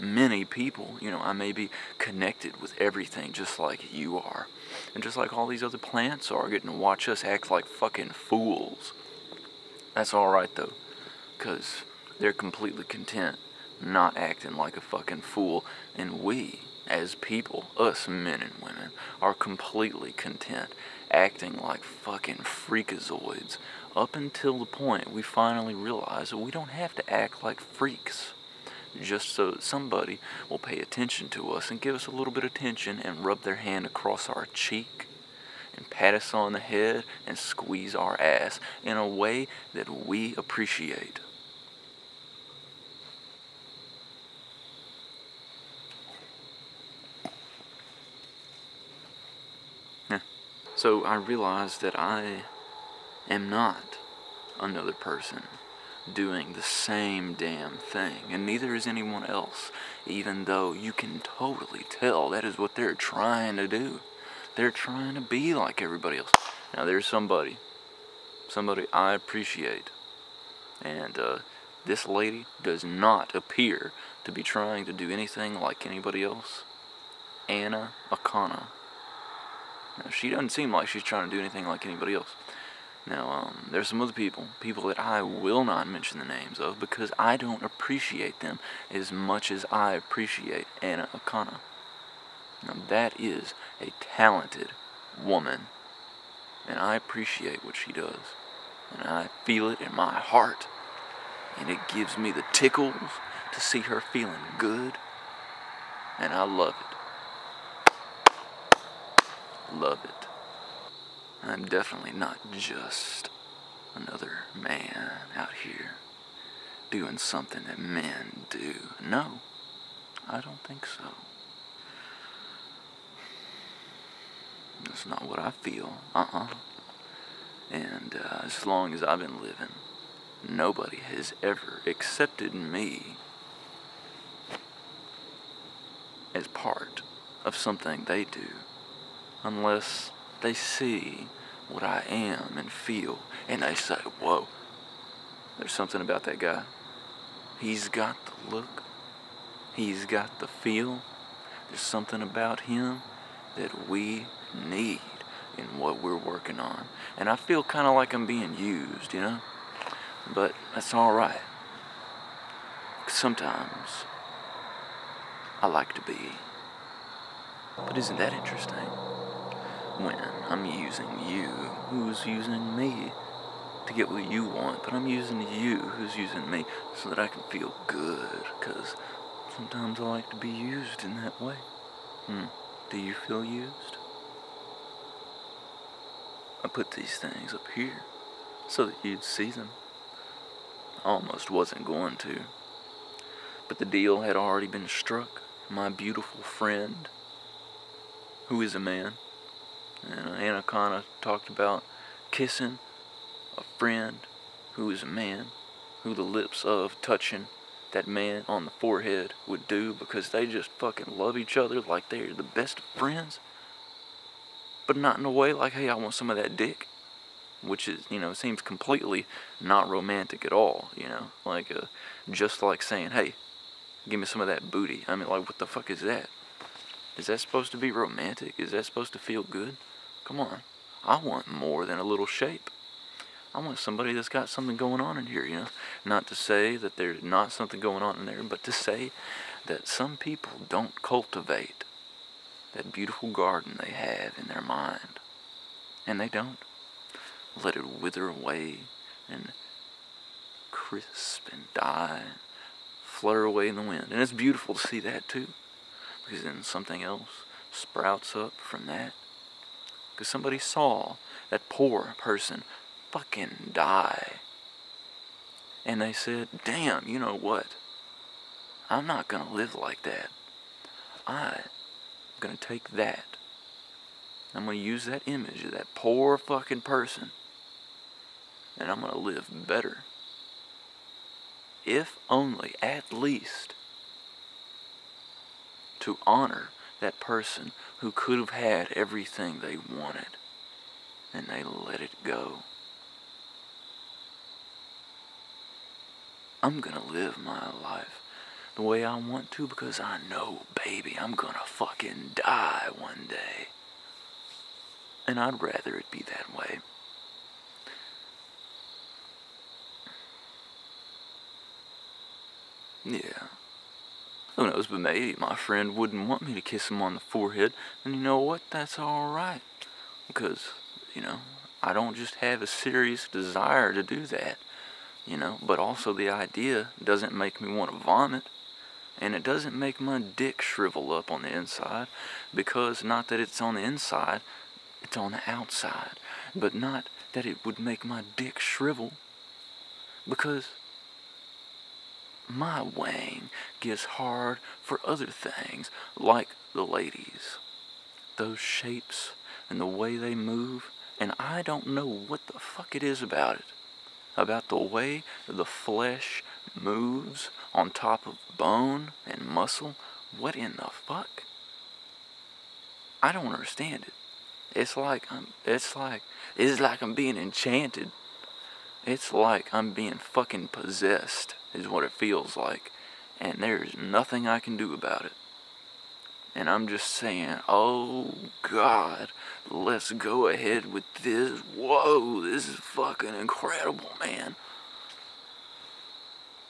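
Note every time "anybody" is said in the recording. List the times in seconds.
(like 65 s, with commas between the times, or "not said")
75 s, 81 s.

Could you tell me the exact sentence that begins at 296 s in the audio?
I'm gonna live my life the way I want to because I know, baby, I'm gonna fucking die one day.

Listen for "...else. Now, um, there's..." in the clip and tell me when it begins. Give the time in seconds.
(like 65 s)
82 s.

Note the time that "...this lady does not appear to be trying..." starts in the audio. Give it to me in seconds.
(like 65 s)
71 s.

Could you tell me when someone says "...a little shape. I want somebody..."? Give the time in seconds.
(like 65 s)
231 s.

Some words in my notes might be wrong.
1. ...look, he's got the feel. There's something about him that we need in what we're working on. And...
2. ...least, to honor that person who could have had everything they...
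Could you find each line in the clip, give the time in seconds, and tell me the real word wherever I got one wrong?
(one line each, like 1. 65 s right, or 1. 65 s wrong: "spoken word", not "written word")
1. 148 s right
2. 283 s right.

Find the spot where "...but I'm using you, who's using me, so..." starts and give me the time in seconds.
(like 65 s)
174 s.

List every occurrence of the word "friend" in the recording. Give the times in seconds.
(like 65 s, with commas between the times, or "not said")
196 s, 203 s, 212 s, 315 s.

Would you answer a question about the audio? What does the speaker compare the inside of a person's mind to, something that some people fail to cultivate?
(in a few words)
beautiful garden.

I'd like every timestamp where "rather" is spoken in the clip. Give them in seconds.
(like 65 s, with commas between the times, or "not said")
305 s.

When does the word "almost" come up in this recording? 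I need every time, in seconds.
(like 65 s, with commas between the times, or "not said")
191 s.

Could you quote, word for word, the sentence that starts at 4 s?
And just like all these other plants are getting to watch us act like fucking fools.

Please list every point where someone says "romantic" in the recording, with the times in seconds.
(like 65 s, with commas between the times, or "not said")
219 s, 227 s.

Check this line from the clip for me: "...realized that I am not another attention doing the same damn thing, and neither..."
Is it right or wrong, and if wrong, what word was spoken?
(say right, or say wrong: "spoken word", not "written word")
wrong: "person", not "attention".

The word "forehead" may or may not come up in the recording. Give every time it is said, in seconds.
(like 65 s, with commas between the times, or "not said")
208 s, 317 s.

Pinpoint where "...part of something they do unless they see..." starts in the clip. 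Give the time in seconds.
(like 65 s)
136 s.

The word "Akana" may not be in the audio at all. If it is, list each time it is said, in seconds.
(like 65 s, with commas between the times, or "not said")
78 s, 91 s, 200 s.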